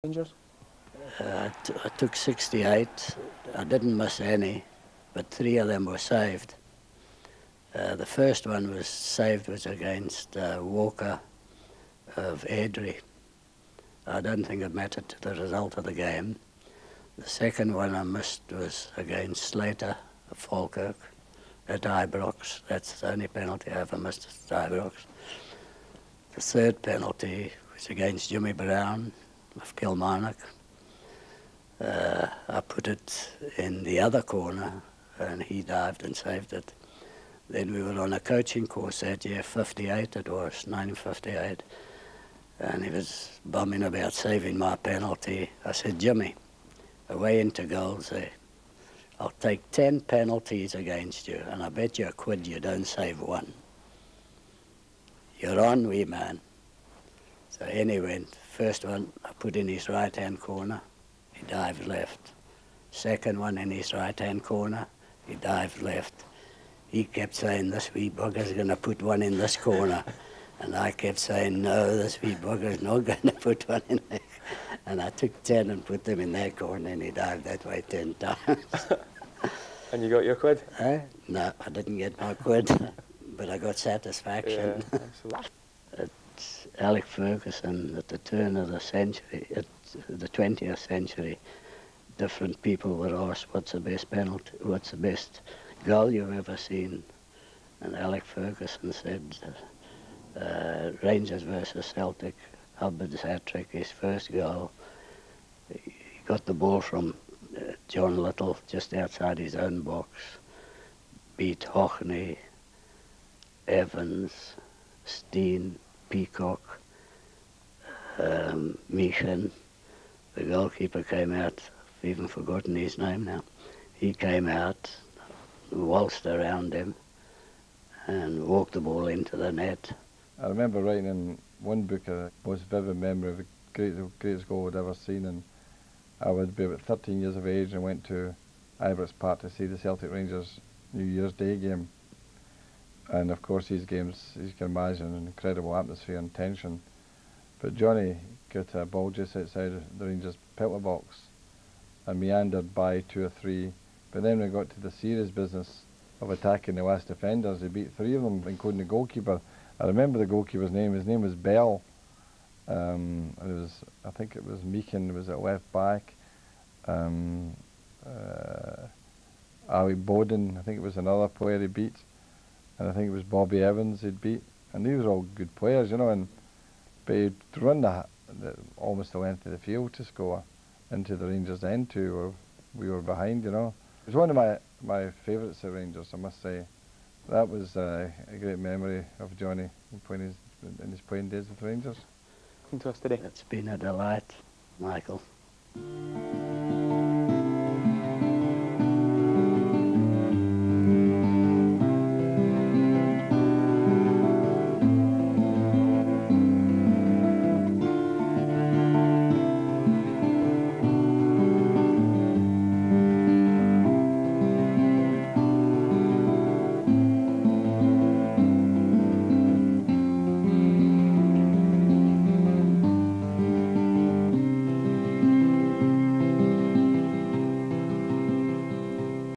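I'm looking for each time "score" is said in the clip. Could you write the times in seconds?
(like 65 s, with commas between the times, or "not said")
180 s.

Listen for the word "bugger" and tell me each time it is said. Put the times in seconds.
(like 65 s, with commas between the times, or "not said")
68 s, 72 s.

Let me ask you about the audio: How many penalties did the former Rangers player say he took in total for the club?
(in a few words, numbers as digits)
68.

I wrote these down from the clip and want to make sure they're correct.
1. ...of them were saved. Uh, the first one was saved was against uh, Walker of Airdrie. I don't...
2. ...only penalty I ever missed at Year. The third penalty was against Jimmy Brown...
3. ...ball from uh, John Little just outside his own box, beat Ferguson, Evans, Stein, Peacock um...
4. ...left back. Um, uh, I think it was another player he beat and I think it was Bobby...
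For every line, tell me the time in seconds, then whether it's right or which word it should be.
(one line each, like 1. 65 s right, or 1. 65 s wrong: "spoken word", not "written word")
1. 5 s right
2. 23 s wrong: "Ibrox", not "Year"
3. 106 s wrong: "Haughney", not "Ferguson"
4. 165 s right.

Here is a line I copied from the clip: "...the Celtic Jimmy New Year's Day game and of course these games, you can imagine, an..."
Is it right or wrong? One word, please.
wrong.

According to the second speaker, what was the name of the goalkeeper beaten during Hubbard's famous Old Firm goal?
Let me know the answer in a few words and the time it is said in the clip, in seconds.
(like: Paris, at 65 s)
Bell, at 161 s.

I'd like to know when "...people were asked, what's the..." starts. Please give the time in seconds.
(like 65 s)
92 s.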